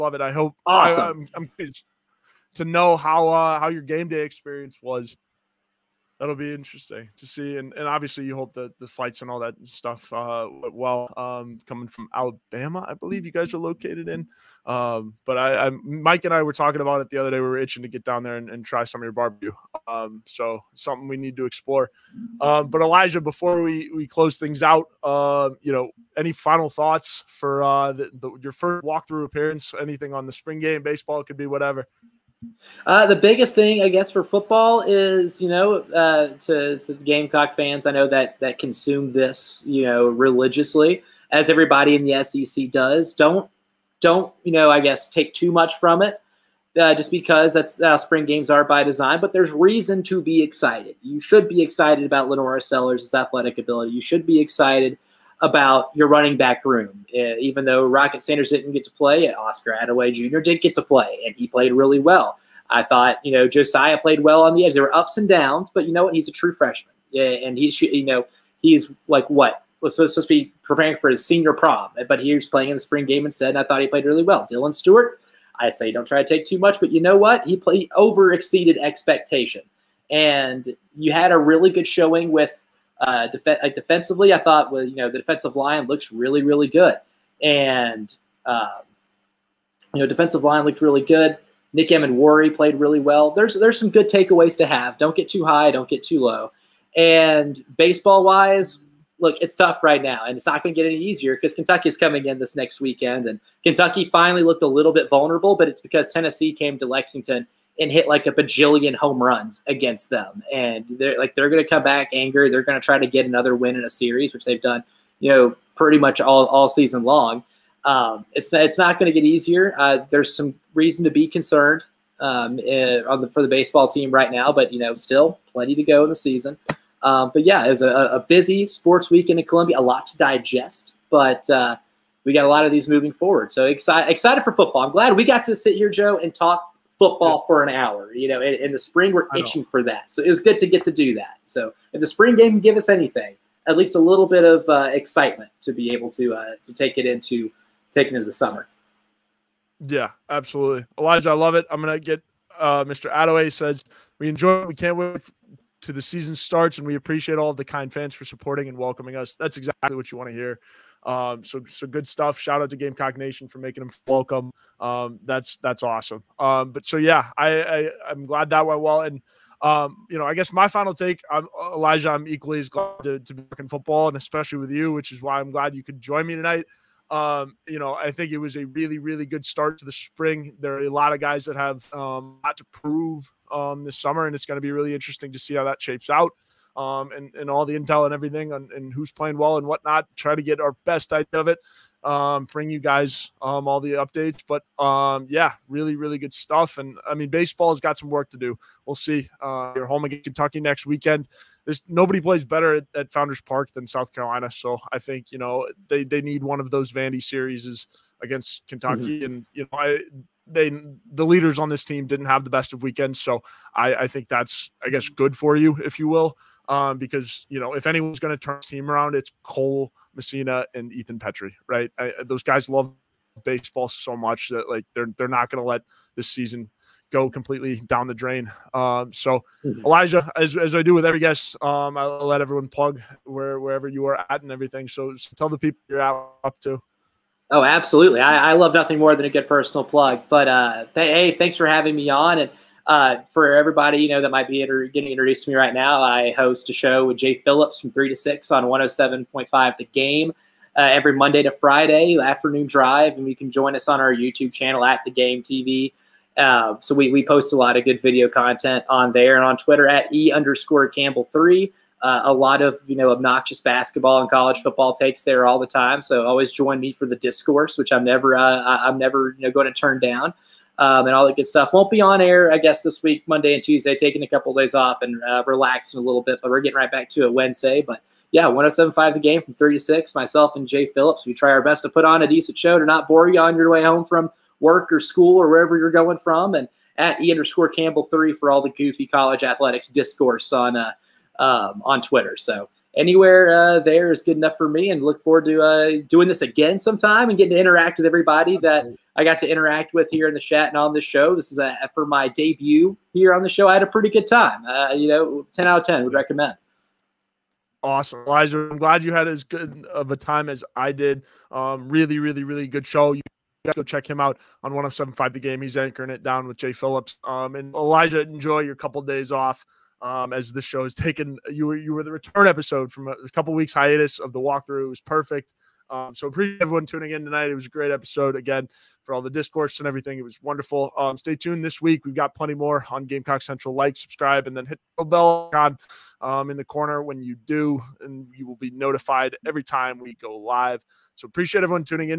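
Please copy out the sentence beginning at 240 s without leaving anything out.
But uh, th- hey, thanks for having me on and.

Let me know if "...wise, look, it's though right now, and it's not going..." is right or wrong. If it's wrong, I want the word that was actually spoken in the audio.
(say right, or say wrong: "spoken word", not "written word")
wrong: "tough", not "though".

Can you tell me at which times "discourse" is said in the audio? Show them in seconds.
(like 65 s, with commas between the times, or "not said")
267 s, 289 s, 329 s.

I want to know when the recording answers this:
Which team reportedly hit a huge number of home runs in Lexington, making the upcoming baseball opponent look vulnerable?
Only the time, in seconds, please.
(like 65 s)
106 s.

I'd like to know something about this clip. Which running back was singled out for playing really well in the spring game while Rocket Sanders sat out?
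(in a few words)
Oscar Adaway Jr.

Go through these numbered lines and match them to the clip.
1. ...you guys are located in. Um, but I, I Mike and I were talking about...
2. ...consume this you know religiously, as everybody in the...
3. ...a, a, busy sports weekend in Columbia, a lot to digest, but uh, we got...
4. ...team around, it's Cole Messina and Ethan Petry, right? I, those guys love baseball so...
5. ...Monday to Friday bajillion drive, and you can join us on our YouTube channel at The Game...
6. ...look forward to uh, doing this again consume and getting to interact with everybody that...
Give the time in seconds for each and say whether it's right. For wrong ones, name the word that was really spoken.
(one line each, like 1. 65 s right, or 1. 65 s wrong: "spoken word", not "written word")
1. 13 s right
2. 38 s right
3. 127 s right
4. 218 s right
5. 251 s wrong: "afternoon", not "bajillion"
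6. 295 s wrong: "sometime", not "consume".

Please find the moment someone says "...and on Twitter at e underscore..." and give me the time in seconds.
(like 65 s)
259 s.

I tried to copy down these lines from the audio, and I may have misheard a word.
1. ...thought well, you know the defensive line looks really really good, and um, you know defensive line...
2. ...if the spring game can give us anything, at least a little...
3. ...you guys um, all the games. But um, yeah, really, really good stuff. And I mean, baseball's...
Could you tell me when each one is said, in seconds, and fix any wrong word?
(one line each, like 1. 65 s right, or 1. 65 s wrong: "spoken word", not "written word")
1. 84 s right
2. 141 s right
3. 192 s wrong: "updates", not "games".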